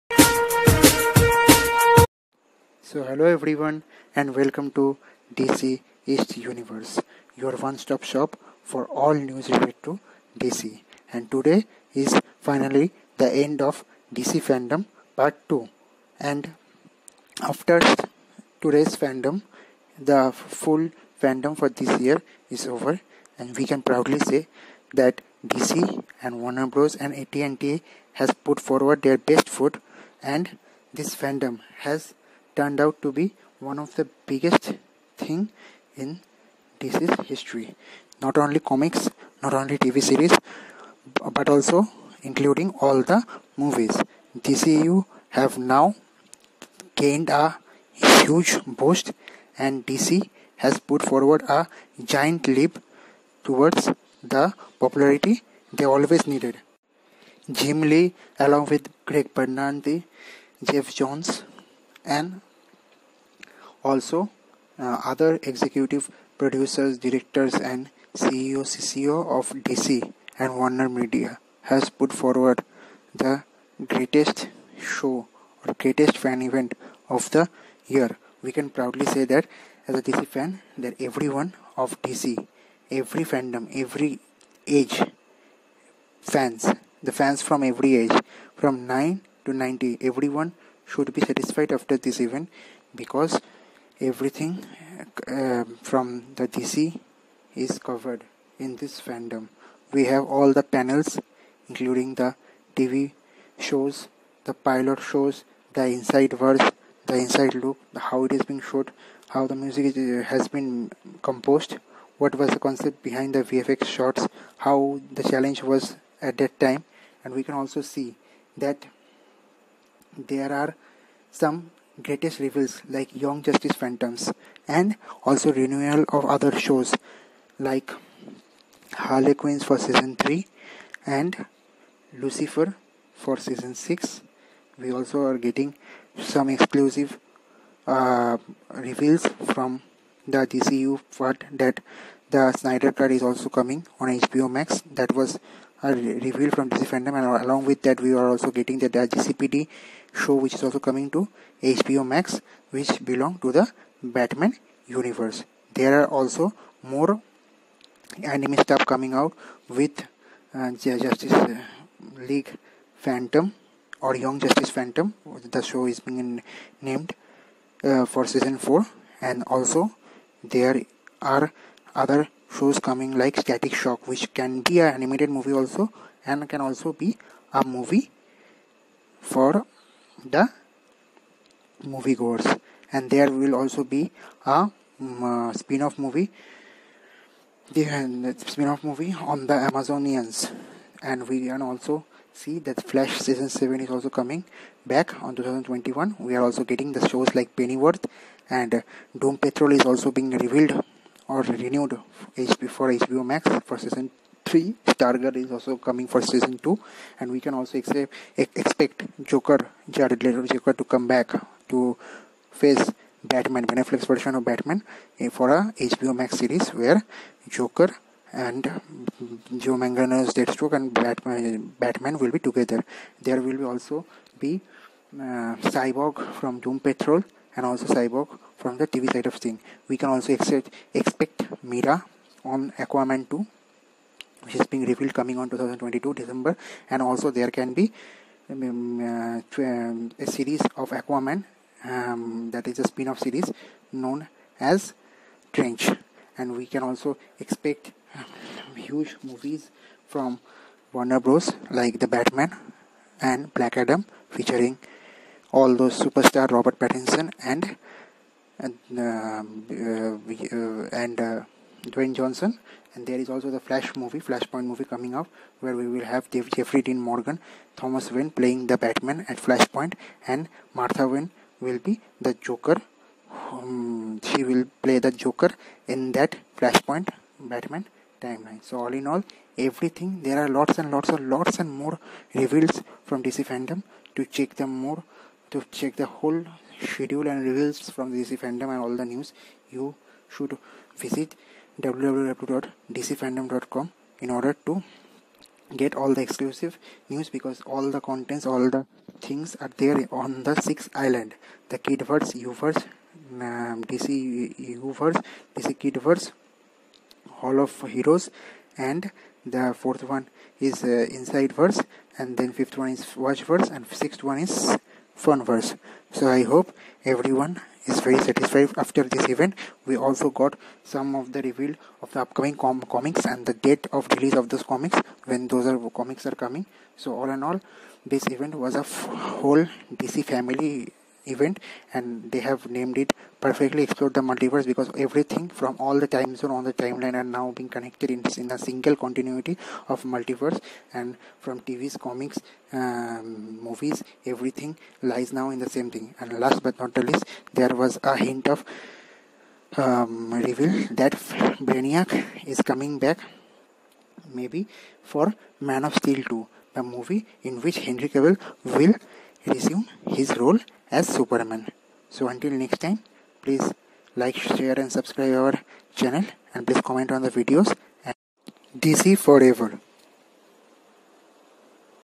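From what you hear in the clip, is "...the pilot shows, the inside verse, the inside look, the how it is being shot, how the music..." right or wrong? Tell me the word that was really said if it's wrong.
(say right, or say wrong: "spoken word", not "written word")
right.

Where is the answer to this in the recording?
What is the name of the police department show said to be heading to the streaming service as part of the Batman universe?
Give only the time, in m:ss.
2:29.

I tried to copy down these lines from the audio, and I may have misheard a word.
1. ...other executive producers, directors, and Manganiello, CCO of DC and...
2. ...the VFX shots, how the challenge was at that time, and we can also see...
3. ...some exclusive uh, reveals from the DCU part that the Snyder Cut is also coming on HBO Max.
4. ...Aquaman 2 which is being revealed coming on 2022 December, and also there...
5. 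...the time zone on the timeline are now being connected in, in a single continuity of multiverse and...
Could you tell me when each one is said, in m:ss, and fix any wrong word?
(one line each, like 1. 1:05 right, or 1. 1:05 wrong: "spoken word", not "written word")
1. 1:05 wrong: "CEO", not "Manganiello"
2. 1:53 right
3. 2:16 right
4. 3:52 right
5. 5:35 right.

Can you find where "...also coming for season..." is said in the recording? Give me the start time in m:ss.
3:25.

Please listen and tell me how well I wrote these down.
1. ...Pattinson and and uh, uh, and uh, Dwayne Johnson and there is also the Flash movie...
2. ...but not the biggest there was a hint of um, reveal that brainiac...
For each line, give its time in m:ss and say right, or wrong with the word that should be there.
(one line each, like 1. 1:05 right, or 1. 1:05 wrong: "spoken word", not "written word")
1. 4:16 right
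2. 5:46 wrong: "least", not "biggest".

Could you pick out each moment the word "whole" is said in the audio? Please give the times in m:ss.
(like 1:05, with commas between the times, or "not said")
4:46, 5:29.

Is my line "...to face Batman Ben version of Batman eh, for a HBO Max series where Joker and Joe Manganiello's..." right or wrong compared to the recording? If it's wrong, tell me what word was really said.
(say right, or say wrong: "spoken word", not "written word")
right.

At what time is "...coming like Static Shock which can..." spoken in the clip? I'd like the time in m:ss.
2:52.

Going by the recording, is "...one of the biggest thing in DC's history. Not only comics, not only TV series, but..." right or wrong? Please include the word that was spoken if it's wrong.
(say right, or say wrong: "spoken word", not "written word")
right.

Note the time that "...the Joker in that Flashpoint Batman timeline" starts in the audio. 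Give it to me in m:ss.
4:34.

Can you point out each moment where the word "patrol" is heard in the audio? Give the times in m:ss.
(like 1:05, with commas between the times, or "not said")
3:19, 3:46.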